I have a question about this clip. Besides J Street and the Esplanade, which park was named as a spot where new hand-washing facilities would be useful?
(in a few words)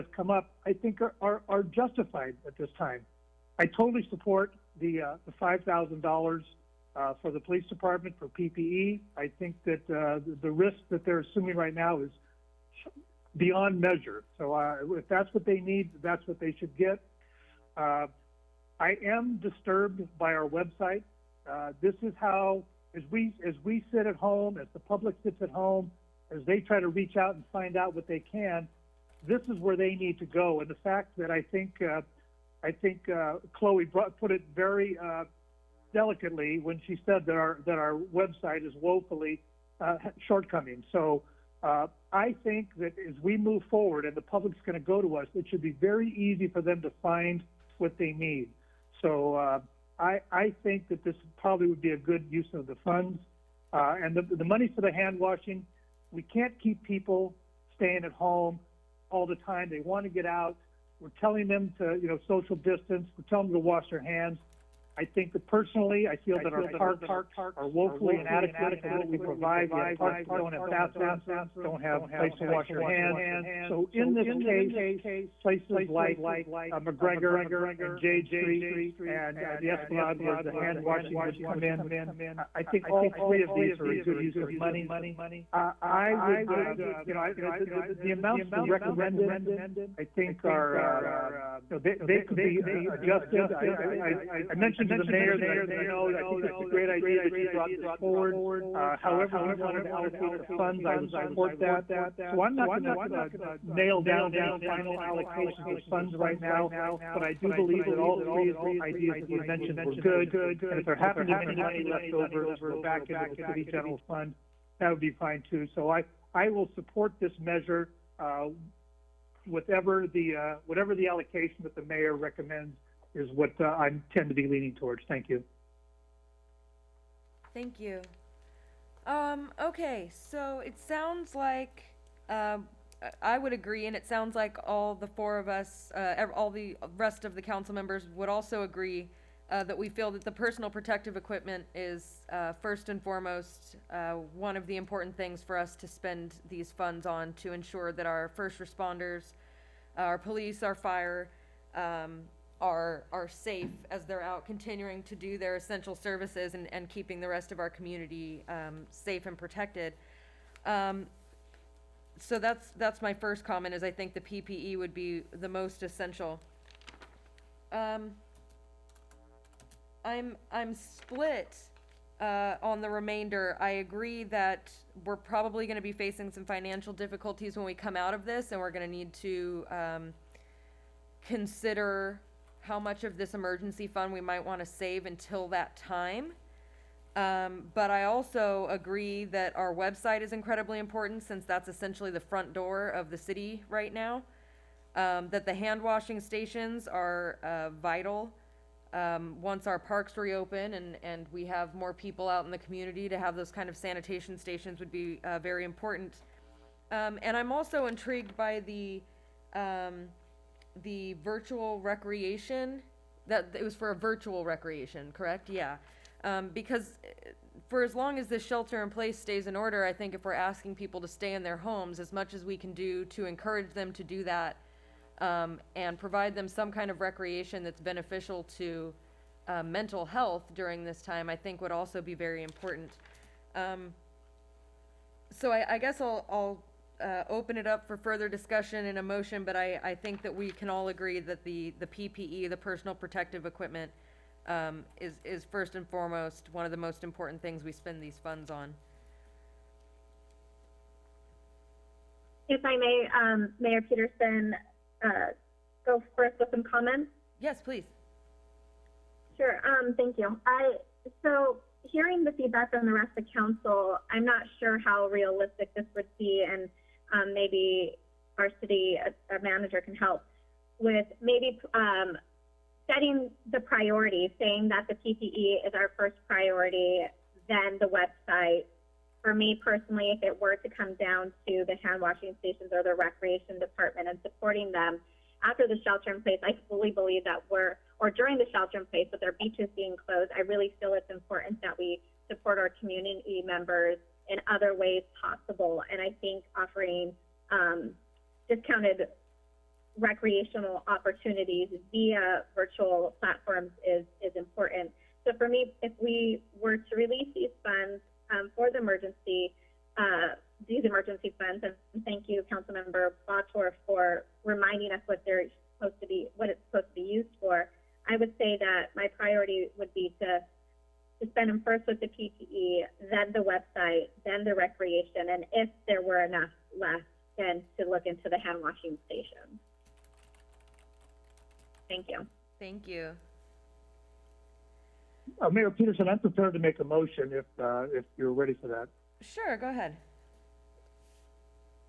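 McGregor.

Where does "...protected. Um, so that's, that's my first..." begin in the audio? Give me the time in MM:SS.
02:39.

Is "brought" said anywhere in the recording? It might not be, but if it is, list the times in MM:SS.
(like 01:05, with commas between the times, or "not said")
00:33, 01:37.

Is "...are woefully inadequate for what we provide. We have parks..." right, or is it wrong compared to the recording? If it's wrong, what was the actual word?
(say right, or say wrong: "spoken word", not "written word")
right.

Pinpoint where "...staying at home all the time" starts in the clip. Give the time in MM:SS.
00:57.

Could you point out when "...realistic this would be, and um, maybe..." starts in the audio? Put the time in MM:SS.
04:25.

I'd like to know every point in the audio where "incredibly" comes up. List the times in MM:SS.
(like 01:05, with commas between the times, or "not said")
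03:10.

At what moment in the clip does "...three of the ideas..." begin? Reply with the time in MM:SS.
01:48.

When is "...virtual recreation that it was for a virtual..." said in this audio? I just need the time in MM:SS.
03:31.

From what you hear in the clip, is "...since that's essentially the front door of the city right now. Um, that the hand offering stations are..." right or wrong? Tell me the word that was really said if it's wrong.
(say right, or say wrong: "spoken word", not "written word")
wrong: "washing", not "offering".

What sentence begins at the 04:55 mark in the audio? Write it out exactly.
And I think offering um, discounted recreational opportunities via virtual platforms is, is important.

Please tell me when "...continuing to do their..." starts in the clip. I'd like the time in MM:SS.
02:34.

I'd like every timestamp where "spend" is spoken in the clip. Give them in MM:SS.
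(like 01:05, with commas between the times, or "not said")
02:25, 04:07, 05:21.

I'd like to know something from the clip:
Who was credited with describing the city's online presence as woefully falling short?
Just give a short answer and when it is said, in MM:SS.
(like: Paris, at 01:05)
Chloe, at 00:33.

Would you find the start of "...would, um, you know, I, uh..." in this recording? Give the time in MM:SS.
01:26.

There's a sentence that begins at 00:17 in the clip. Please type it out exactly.
Uh, I am disturbed by our website.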